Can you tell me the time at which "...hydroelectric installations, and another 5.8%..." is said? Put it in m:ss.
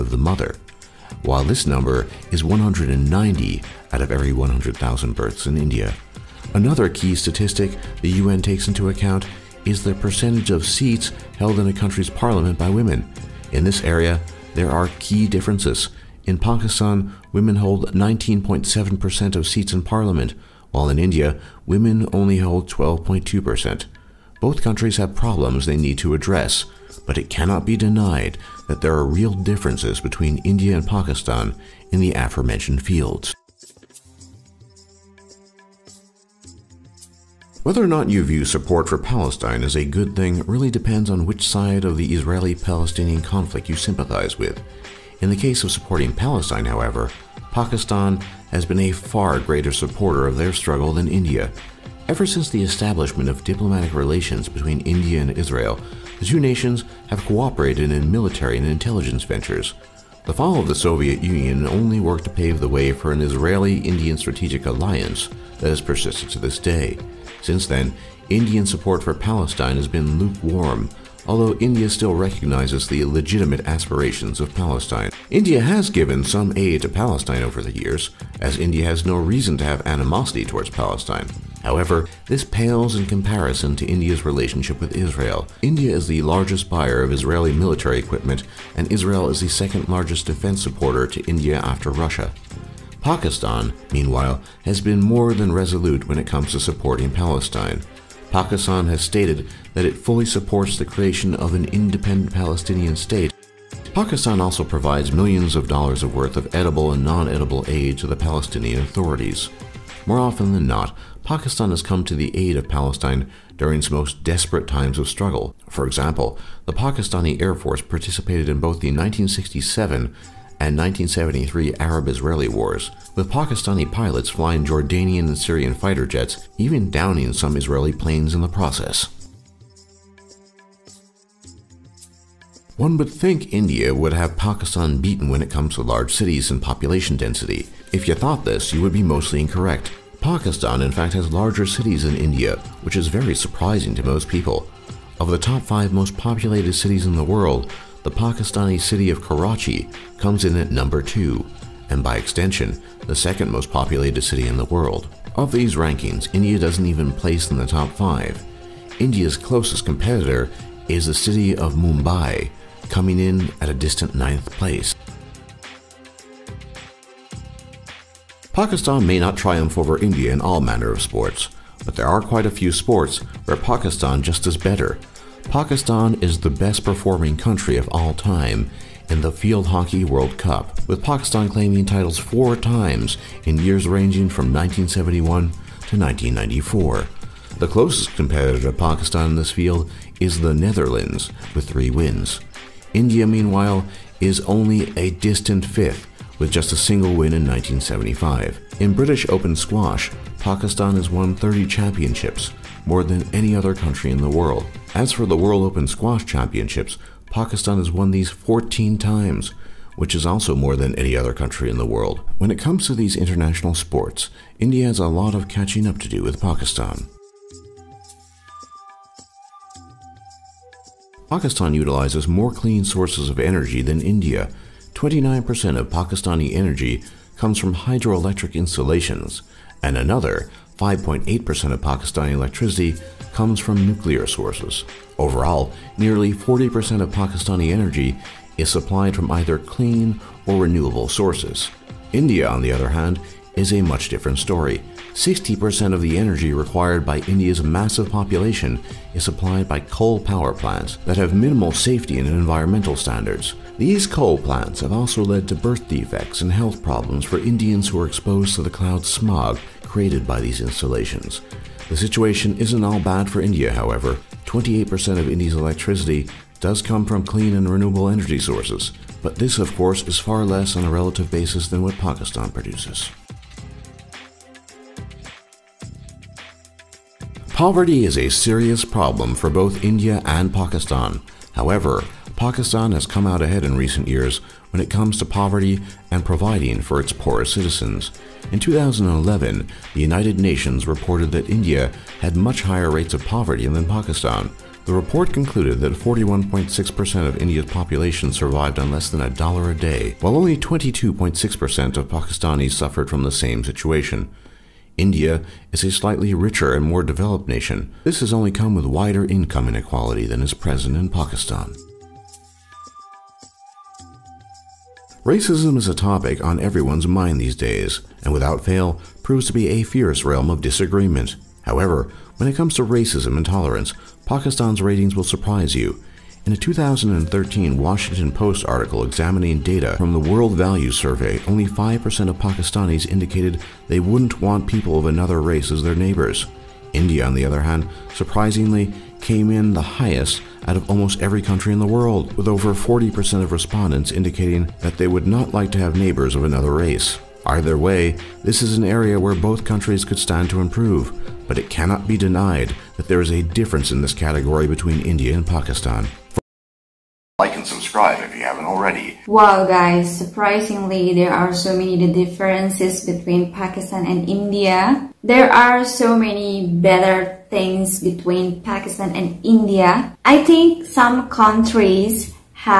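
3:47.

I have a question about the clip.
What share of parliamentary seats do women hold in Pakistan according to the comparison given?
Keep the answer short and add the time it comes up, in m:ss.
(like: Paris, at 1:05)
19.7%, at 0:17.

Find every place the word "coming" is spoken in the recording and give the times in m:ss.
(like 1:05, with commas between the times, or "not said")
2:42.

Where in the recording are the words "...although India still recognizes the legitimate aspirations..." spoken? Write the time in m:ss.
1:11.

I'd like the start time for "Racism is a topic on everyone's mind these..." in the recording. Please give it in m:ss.
5:15.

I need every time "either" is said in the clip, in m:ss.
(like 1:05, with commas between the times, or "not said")
3:59, 5:47.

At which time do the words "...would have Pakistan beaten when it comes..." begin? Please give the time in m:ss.
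2:13.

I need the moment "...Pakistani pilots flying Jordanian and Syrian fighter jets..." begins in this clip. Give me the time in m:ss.
2:03.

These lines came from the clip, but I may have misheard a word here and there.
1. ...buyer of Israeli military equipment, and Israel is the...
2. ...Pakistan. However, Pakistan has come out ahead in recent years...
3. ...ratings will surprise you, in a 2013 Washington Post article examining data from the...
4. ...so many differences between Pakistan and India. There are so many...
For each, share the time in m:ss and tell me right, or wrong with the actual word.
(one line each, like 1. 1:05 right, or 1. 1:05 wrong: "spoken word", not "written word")
1. 1:26 right
2. 4:40 right
3. 5:24 right
4. 6:01 right.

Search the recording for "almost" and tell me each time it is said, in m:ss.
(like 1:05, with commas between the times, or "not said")
5:40.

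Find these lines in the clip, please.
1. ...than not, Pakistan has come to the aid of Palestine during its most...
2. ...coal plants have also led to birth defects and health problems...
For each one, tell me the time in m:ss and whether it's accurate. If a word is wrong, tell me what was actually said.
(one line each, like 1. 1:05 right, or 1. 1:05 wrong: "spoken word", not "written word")
1. 1:50 right
2. 4:14 right.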